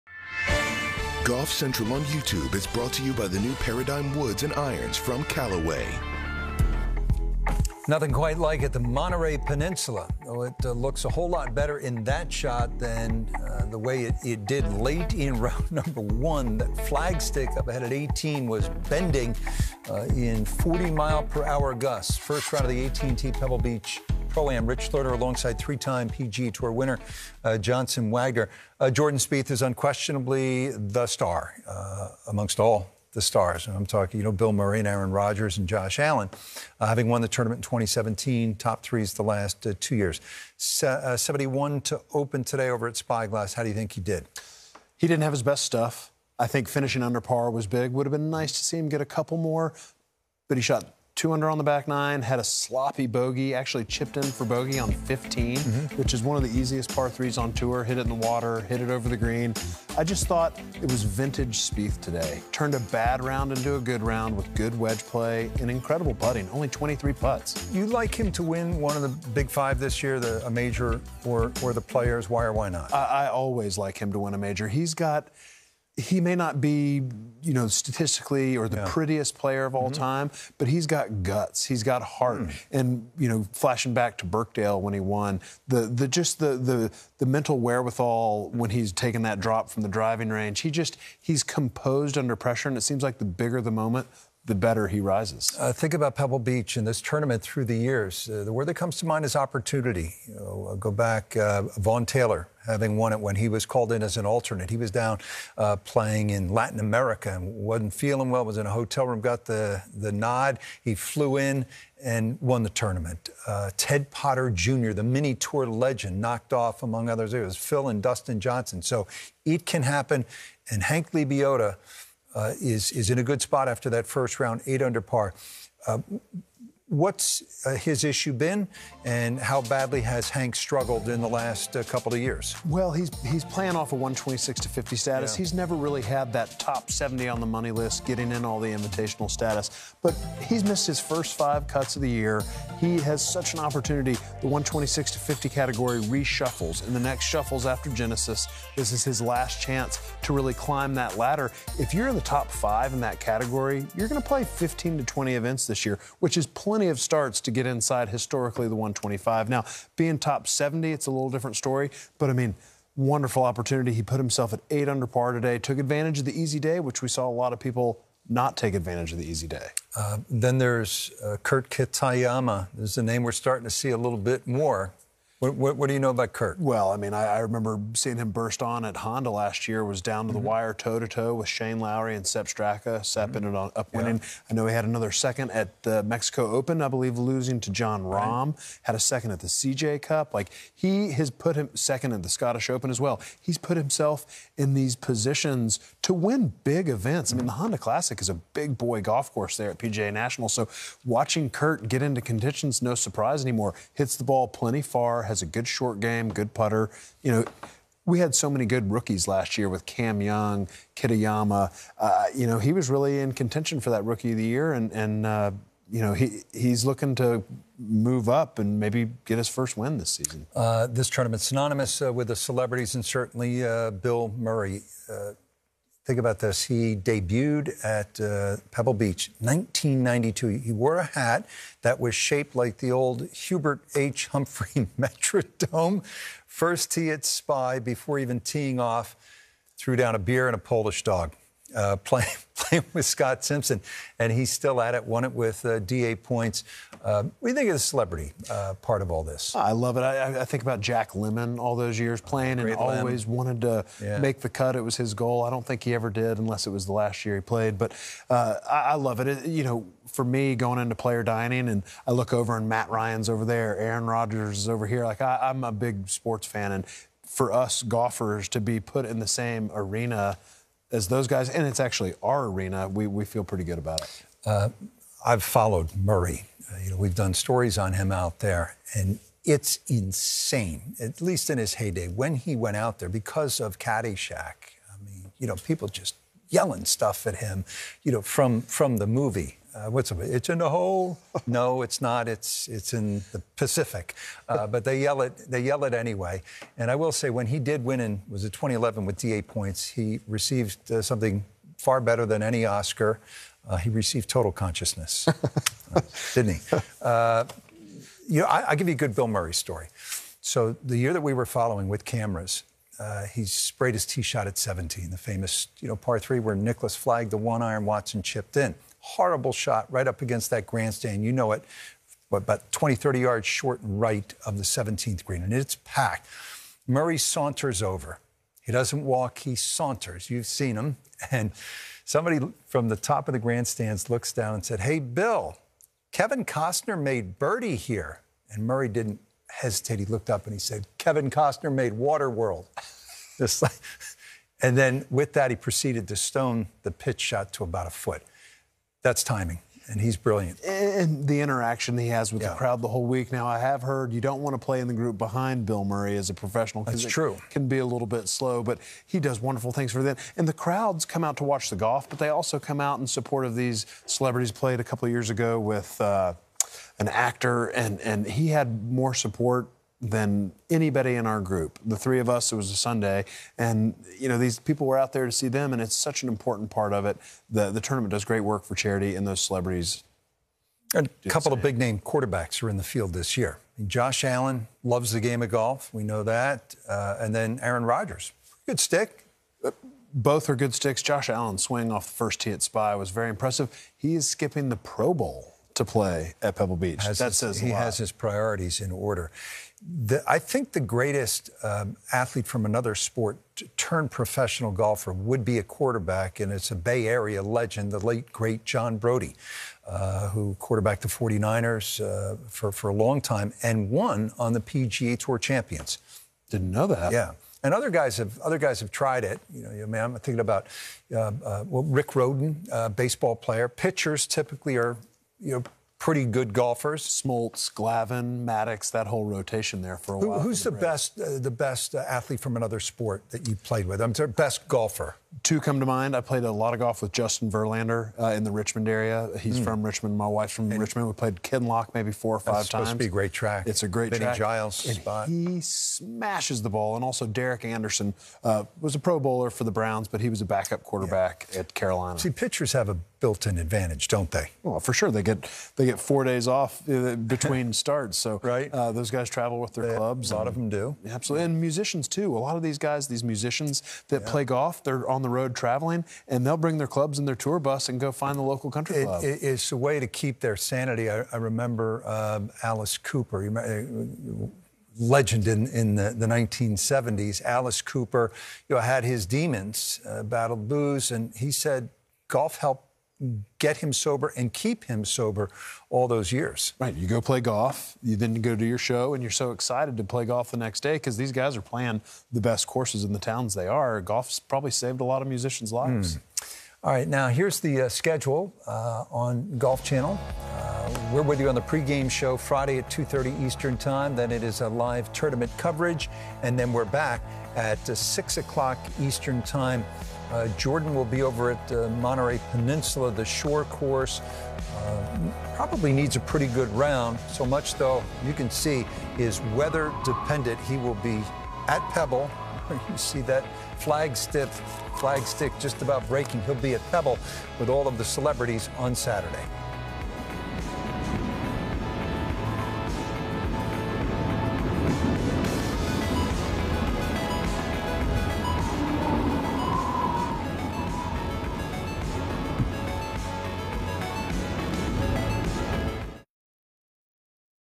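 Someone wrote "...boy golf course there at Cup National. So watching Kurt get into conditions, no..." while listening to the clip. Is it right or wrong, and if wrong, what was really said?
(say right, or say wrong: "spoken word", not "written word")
wrong: "PGA", not "Cup".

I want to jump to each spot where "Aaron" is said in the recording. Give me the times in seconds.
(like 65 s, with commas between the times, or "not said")
34 s, 263 s, 387 s.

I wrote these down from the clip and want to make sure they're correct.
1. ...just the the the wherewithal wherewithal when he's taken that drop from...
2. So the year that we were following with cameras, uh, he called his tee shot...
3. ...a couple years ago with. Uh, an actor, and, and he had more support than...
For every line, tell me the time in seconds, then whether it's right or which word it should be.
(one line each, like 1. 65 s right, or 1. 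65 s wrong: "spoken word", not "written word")
1. 86 s wrong: "mental", not "wherewithal"
2. 310 s wrong: "sprayed", not "called"
3. 364 s right.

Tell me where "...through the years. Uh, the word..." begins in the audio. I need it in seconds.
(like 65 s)
97 s.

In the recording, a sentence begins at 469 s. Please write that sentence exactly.
It, it's a way to keep their sanity.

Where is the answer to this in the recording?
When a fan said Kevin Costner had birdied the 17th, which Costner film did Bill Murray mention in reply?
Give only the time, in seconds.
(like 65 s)
341 s.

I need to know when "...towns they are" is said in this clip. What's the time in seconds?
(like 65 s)
493 s.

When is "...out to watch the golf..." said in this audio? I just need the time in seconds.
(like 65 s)
361 s.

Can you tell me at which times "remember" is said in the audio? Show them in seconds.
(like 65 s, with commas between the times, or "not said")
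177 s, 471 s.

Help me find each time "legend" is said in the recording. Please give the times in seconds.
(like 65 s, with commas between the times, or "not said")
115 s, 407 s, 474 s.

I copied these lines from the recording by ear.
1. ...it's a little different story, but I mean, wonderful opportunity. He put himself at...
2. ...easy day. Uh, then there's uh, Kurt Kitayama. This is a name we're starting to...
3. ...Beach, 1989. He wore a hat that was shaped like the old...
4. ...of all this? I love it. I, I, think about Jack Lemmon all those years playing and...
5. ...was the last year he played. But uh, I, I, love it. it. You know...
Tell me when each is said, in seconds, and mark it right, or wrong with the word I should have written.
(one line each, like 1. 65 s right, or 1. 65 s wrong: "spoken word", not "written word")
1. 160 s right
2. 169 s right
3. 228 s wrong: "1992", not "1989"
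4. 249 s right
5. 256 s right.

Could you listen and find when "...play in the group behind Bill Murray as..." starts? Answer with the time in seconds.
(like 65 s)
354 s.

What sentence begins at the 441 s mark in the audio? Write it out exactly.
We played Kinloch maybe four or five that's times.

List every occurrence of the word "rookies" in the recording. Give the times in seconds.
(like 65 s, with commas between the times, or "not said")
208 s, 214 s.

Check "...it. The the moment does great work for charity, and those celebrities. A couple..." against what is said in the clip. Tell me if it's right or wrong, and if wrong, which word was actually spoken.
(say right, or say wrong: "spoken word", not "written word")
wrong: "tournament", not "moment".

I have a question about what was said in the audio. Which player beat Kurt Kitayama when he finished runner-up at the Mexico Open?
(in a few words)
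Jon Rahm.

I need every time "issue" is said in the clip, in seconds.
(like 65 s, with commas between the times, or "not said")
128 s.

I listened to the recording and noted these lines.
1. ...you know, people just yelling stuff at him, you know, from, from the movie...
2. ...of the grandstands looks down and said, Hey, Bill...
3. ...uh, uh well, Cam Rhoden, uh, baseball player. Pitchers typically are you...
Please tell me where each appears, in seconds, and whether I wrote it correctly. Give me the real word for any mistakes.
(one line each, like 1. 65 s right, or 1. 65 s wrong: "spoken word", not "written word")
1. 285 s right
2. 333 s right
3. 421 s wrong: "Rick", not "Cam".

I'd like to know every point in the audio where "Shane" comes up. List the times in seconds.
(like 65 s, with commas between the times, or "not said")
181 s.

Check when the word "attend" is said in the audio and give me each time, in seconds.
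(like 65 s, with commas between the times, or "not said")
not said.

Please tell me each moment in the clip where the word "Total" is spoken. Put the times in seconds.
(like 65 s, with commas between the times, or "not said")
304 s.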